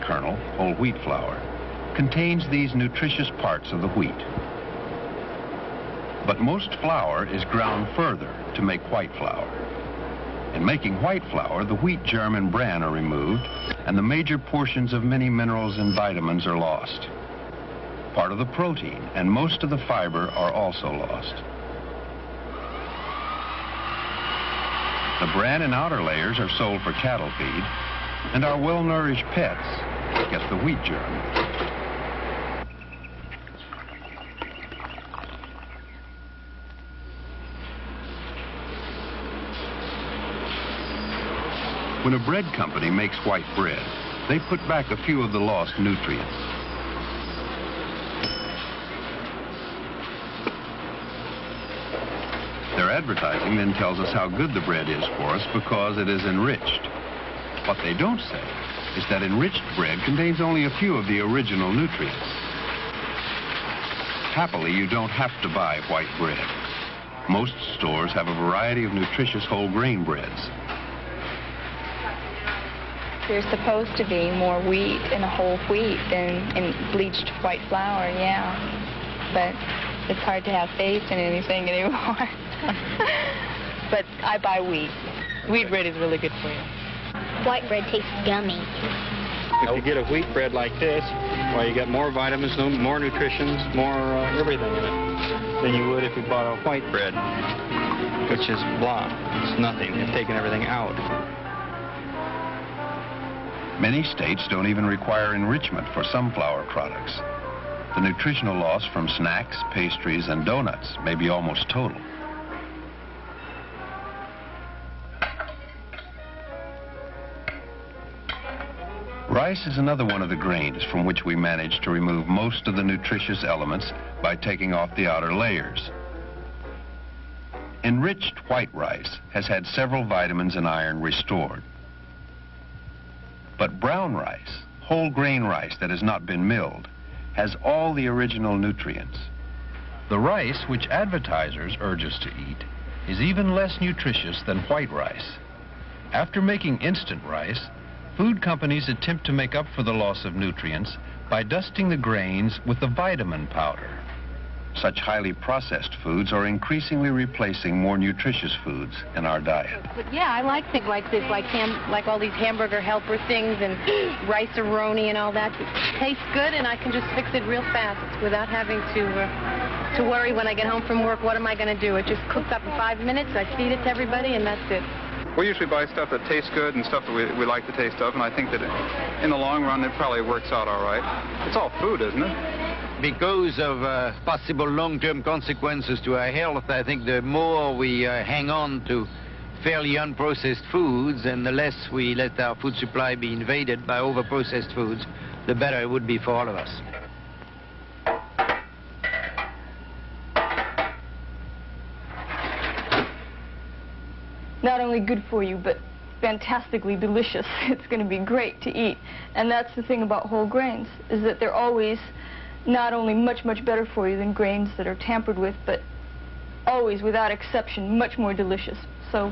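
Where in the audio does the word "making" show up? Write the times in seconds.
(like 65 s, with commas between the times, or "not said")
10 s, 146 s.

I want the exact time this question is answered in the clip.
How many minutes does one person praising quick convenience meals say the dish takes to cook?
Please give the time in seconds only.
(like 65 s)
172 s.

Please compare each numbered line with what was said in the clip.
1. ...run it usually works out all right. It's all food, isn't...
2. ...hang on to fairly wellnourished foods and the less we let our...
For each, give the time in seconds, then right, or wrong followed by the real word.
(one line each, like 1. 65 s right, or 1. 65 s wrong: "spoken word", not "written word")
1. 179 s wrong: "probably", not "usually"
2. 188 s wrong: "unprocessed", not "wellnourished".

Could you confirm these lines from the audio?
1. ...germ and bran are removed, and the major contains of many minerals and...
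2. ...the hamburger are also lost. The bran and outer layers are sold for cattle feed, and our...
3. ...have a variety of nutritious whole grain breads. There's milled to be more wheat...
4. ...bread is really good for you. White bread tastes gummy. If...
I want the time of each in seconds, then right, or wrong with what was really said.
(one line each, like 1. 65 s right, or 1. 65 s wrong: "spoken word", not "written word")
1. 12 s wrong: "portions", not "contains"
2. 19 s wrong: "fiber", not "hamburger"
3. 68 s wrong: "supposed", not "milled"
4. 85 s right.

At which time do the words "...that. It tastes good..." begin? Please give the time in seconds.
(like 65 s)
165 s.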